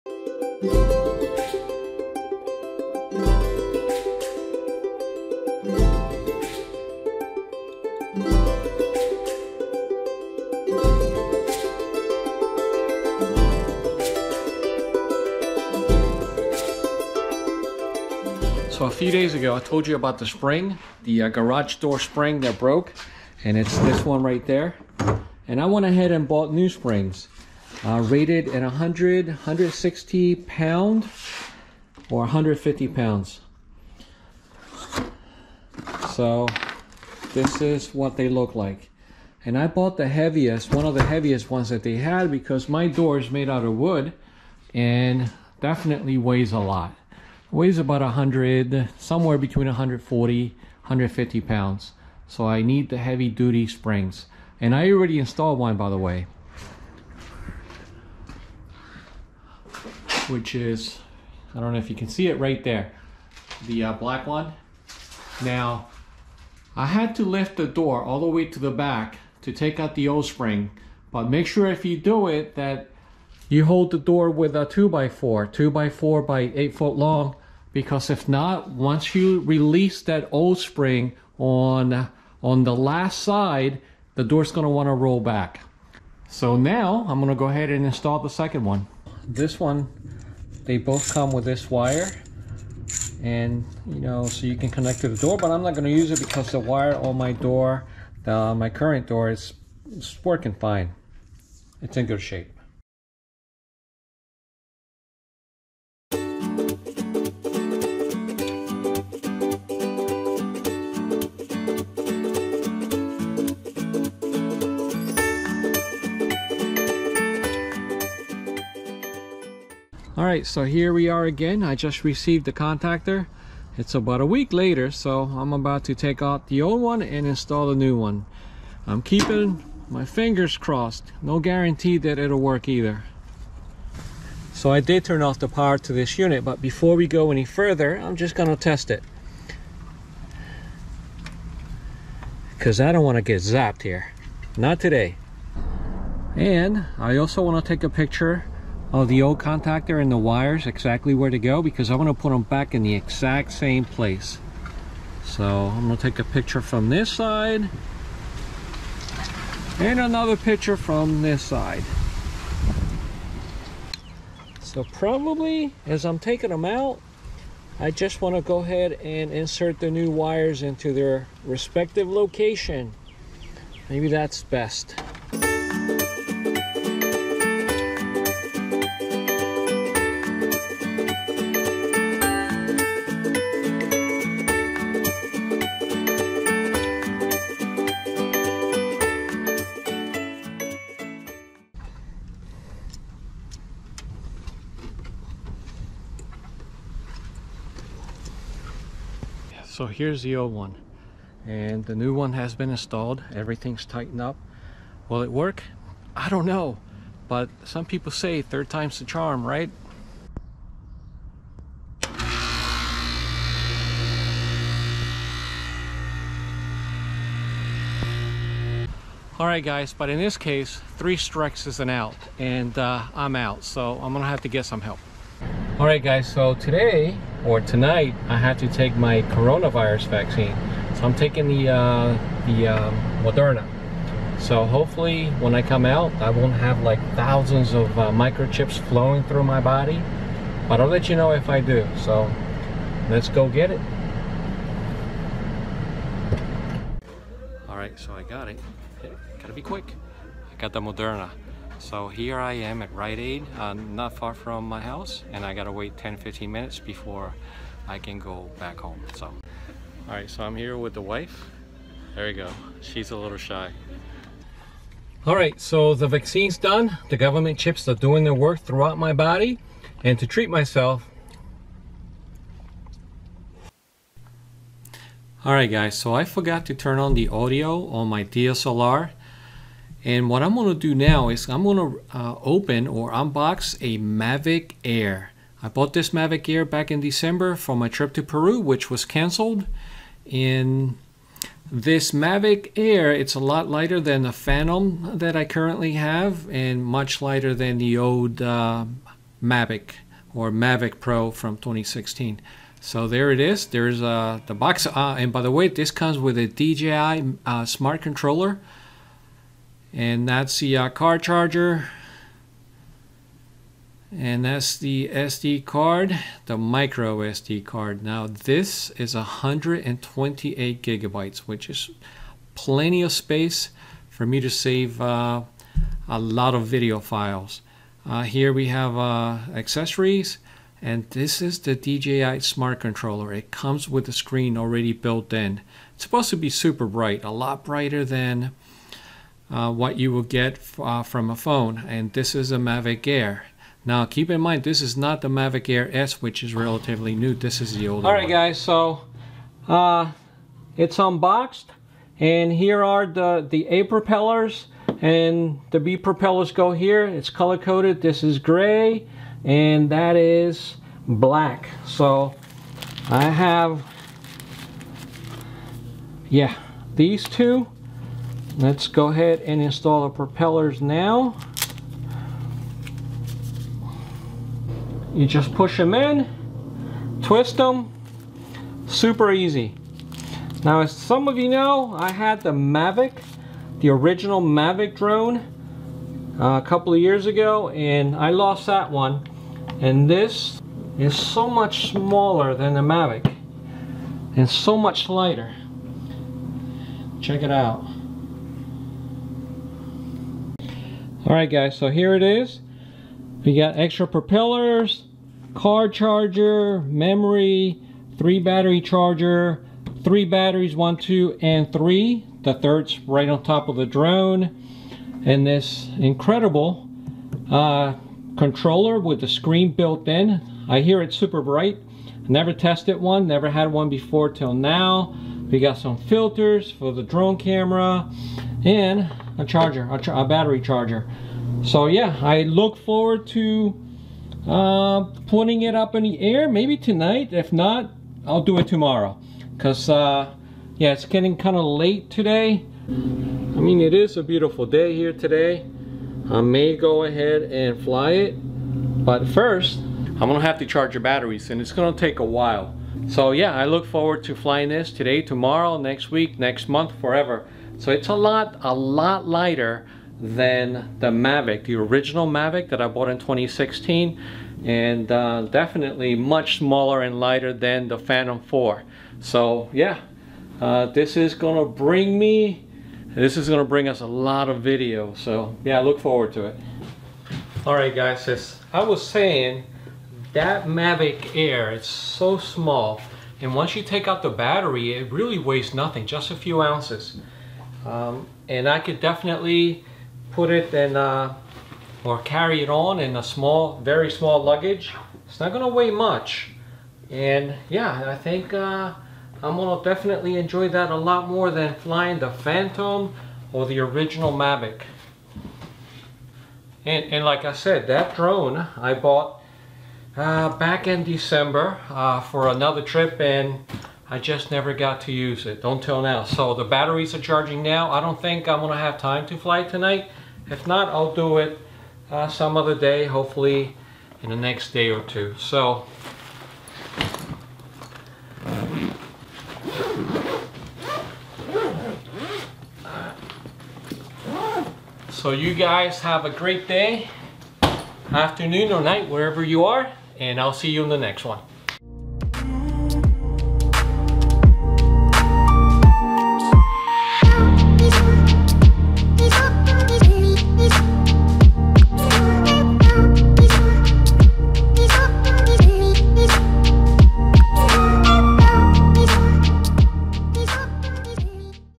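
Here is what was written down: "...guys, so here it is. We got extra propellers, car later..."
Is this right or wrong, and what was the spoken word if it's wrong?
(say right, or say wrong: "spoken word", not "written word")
wrong: "charger", not "later".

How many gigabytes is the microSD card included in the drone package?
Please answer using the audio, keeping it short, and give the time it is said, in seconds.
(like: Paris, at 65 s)
128, at 319 s.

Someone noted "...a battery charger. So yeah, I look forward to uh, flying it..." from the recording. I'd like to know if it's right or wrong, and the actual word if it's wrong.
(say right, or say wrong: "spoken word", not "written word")
wrong: "putting", not "flying".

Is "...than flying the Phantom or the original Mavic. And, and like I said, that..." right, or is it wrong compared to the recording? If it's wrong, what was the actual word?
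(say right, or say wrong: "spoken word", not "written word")
right.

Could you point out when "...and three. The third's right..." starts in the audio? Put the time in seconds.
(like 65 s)
411 s.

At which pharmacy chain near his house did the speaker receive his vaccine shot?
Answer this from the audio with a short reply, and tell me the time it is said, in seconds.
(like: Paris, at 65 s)
Rite Aid, at 252 s.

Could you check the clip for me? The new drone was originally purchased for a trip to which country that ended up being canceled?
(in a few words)
Peru.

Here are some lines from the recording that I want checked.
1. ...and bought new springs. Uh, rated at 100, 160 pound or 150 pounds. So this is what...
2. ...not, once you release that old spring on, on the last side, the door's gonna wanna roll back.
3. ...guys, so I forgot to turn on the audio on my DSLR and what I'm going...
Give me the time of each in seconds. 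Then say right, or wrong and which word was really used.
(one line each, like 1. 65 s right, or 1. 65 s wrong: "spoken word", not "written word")
1. 26 s right
2. 78 s right
3. 275 s right.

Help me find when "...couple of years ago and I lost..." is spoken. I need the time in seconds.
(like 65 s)
386 s.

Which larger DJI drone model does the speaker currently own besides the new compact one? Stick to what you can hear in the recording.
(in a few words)
Phantom 4.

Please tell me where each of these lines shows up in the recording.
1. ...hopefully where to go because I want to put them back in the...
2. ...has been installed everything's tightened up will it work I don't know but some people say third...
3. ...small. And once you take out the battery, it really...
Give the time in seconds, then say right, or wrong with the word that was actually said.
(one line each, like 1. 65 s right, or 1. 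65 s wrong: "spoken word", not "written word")
1. 150 s wrong: "exactly", not "hopefully"
2. 202 s right
3. 482 s right.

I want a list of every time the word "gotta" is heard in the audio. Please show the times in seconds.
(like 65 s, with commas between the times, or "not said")
249 s, 255 s.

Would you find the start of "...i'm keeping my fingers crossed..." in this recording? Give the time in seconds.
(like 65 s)
128 s.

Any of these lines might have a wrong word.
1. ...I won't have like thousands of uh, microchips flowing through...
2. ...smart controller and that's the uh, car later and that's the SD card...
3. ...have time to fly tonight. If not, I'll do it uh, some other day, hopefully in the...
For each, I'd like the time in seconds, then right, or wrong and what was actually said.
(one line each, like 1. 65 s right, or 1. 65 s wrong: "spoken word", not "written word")
1. 236 s right
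2. 307 s wrong: "charger", not "later"
3. 518 s right.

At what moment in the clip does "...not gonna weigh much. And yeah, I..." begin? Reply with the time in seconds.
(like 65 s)
495 s.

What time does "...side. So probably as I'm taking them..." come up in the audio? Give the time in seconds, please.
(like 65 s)
161 s.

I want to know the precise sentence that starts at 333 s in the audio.
It comes with the screen already built in.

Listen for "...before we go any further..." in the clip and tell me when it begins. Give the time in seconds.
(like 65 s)
136 s.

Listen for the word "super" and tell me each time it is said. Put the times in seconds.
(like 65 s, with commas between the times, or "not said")
336 s, 378 s, 421 s.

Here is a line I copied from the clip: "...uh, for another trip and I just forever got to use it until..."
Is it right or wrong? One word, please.
wrong.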